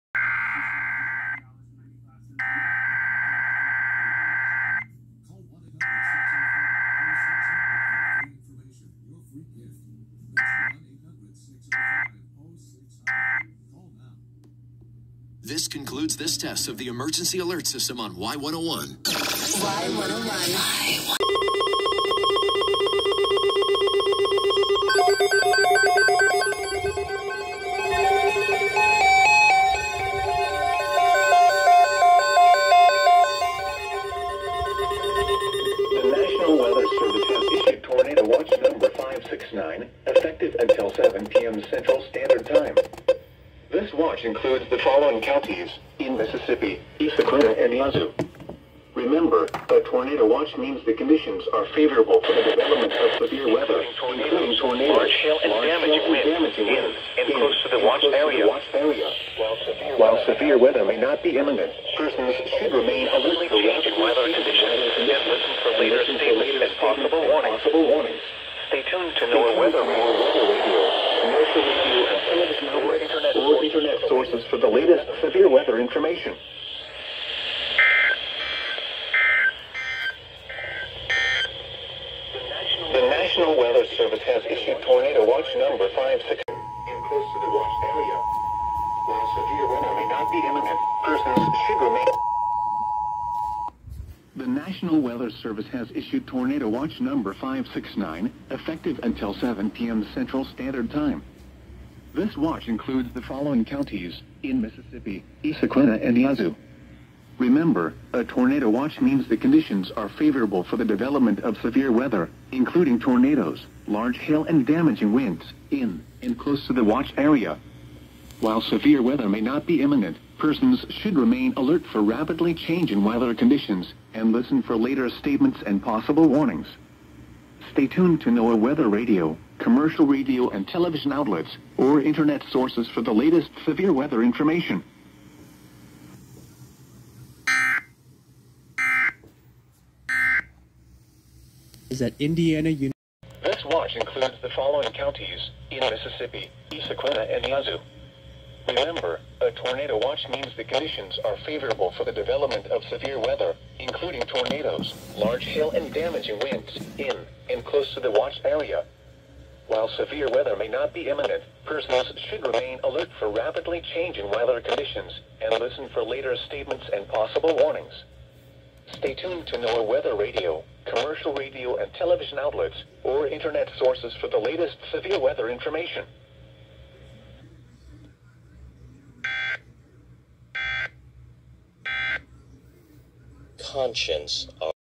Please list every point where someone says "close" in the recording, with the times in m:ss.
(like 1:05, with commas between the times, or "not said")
0:57, 1:26, 1:56, 2:37.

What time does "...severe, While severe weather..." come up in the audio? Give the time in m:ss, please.
0:58.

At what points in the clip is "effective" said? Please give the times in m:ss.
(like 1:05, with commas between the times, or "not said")
0:40, 1:38.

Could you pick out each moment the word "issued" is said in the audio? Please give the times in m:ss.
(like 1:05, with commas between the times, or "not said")
0:37, 1:24, 1:35.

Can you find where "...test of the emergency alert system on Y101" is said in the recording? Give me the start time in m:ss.
0:16.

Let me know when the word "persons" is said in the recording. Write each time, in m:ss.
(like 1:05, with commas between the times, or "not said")
1:01, 1:31, 2:00, 2:41.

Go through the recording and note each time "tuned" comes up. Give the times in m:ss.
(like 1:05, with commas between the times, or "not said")
1:08, 2:07, 2:49.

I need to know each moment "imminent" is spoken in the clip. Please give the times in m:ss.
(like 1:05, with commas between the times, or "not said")
1:01, 1:30, 1:59, 2:41.